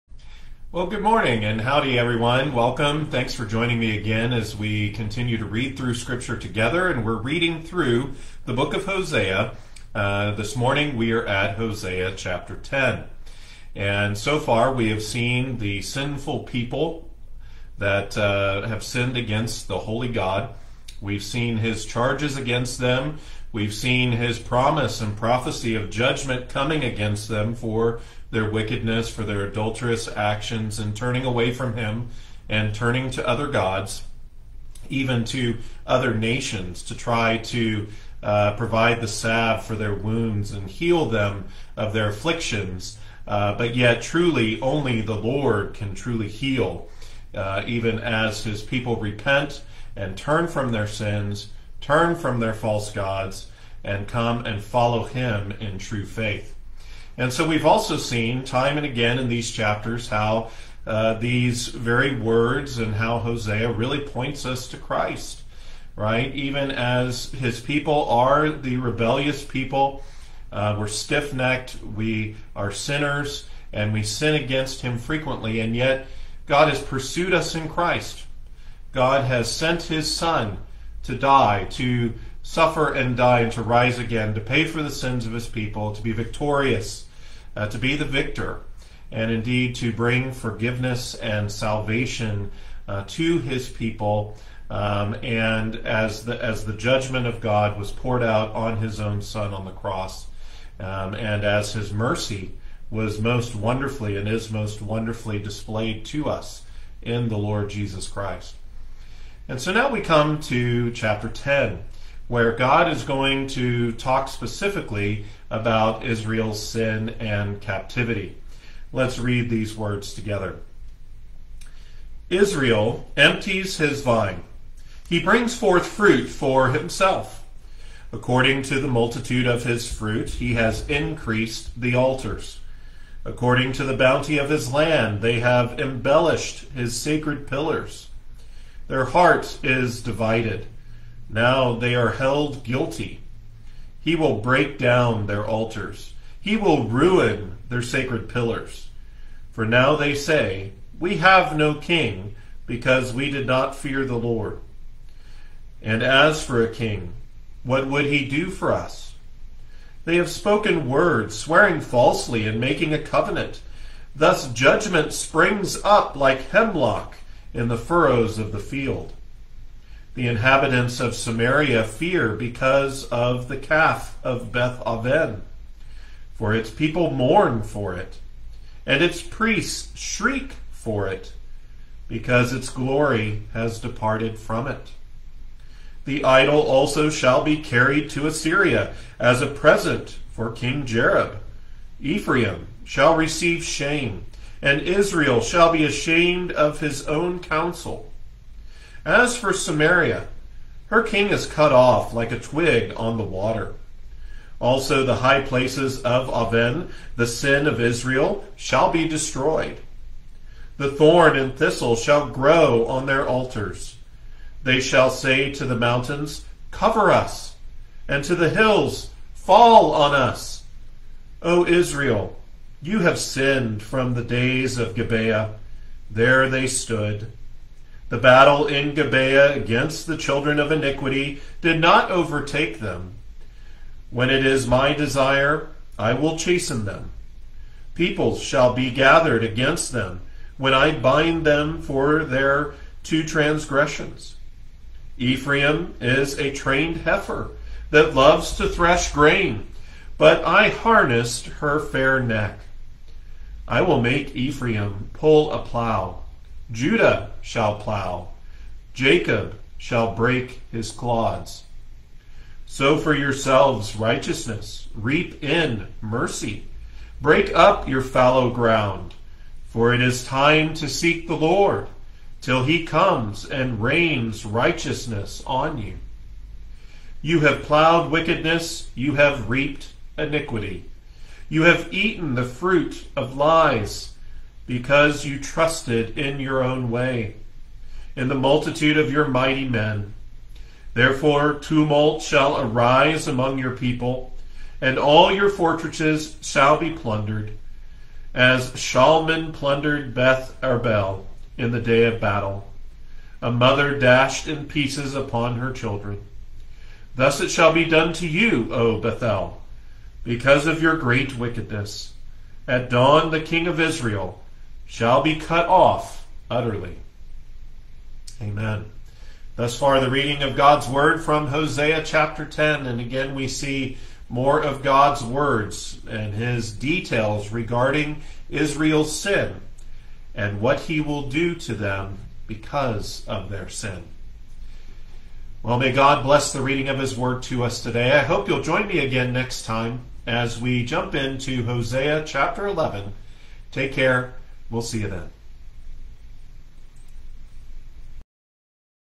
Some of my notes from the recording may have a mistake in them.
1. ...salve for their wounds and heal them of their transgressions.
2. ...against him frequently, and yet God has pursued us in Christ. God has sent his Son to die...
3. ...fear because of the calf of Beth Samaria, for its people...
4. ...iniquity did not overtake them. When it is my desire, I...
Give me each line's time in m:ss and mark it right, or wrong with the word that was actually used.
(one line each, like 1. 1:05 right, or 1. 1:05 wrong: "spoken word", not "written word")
1. 0:39 wrong: "afflictions", not "transgressions"
2. 1:14 right
3. 2:51 wrong: "Aven", not "Samaria"
4. 3:50 right.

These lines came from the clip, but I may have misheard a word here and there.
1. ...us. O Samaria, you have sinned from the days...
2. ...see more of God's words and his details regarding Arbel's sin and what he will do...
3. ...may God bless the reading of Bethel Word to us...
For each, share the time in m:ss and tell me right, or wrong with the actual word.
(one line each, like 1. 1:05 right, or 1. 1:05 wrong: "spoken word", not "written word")
1. 3:40 wrong: "Israel", not "Samaria"
2. 5:23 wrong: "Israel", not "Arbel"
3. 5:35 wrong: "His", not "Bethel".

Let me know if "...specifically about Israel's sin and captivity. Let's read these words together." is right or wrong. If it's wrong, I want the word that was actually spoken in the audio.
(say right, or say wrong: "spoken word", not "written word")
right.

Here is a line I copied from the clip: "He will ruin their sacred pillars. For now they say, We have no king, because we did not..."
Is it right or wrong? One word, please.
right.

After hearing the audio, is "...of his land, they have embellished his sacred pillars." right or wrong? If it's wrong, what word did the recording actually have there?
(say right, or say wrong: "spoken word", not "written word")
right.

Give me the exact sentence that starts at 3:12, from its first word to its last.
Ephraim shall receive shame, and Israel shall be ashamed of his own counsel.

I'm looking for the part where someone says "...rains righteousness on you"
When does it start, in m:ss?
4:33.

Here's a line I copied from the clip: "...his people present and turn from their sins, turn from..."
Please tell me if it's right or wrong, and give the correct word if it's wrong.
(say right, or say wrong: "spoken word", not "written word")
wrong: "repent", not "present".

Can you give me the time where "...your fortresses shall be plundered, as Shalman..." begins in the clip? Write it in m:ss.
4:55.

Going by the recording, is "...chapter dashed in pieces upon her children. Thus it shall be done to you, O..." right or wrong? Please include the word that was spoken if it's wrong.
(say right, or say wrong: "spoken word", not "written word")
wrong: "mother", not "chapter".